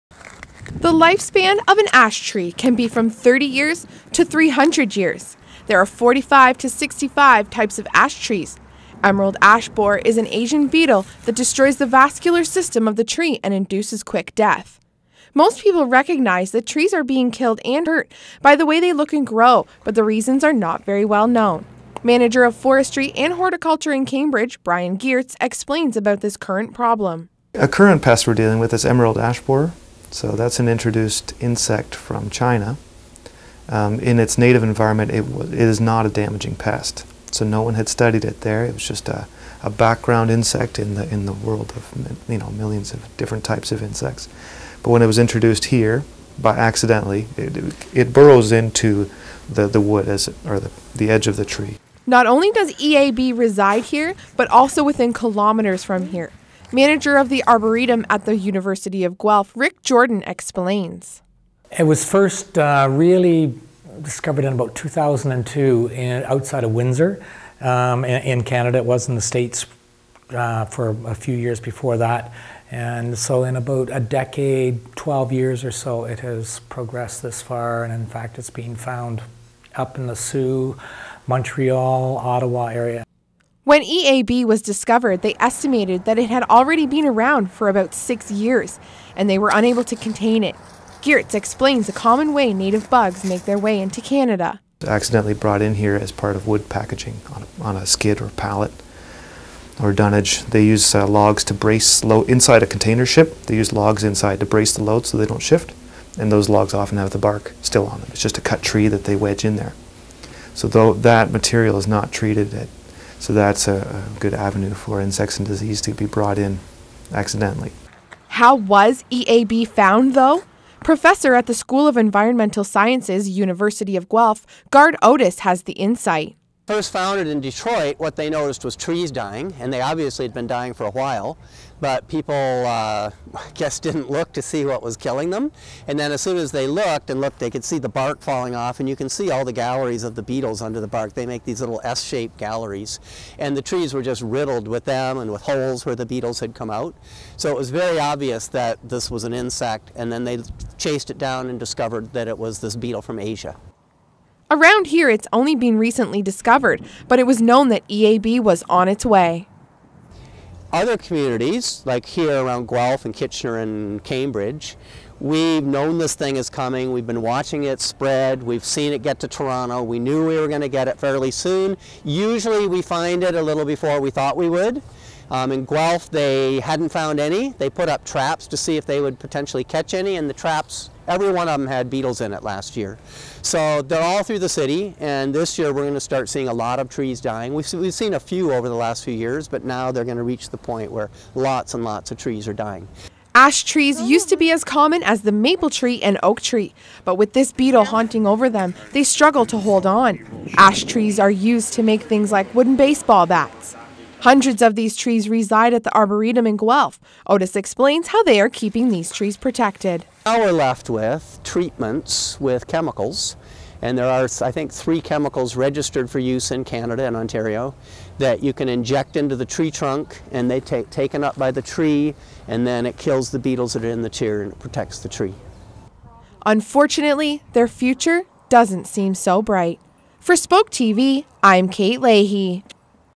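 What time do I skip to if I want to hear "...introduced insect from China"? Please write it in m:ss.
0:30.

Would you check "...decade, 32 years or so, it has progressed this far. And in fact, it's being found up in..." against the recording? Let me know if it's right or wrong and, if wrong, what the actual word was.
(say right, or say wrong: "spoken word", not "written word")
wrong: "12", not "32".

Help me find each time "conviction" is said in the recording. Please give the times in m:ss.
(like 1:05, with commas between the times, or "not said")
not said.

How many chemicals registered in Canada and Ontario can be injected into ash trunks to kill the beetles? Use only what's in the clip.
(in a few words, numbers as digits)
3.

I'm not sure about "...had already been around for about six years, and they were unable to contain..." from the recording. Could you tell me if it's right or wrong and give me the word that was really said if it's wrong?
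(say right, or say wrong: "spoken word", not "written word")
right.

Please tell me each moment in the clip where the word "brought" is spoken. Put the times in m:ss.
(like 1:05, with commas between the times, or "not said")
1:35, 1:56.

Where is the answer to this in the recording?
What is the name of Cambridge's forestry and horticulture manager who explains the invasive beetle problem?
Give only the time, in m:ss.
0:24.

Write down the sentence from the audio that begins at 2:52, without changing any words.
Usually we find it a little before we thought we would.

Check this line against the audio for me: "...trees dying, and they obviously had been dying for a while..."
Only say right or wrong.
right.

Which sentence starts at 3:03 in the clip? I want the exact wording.
So they're all through the city, and this year we're going to start seeing a lot of trees dying.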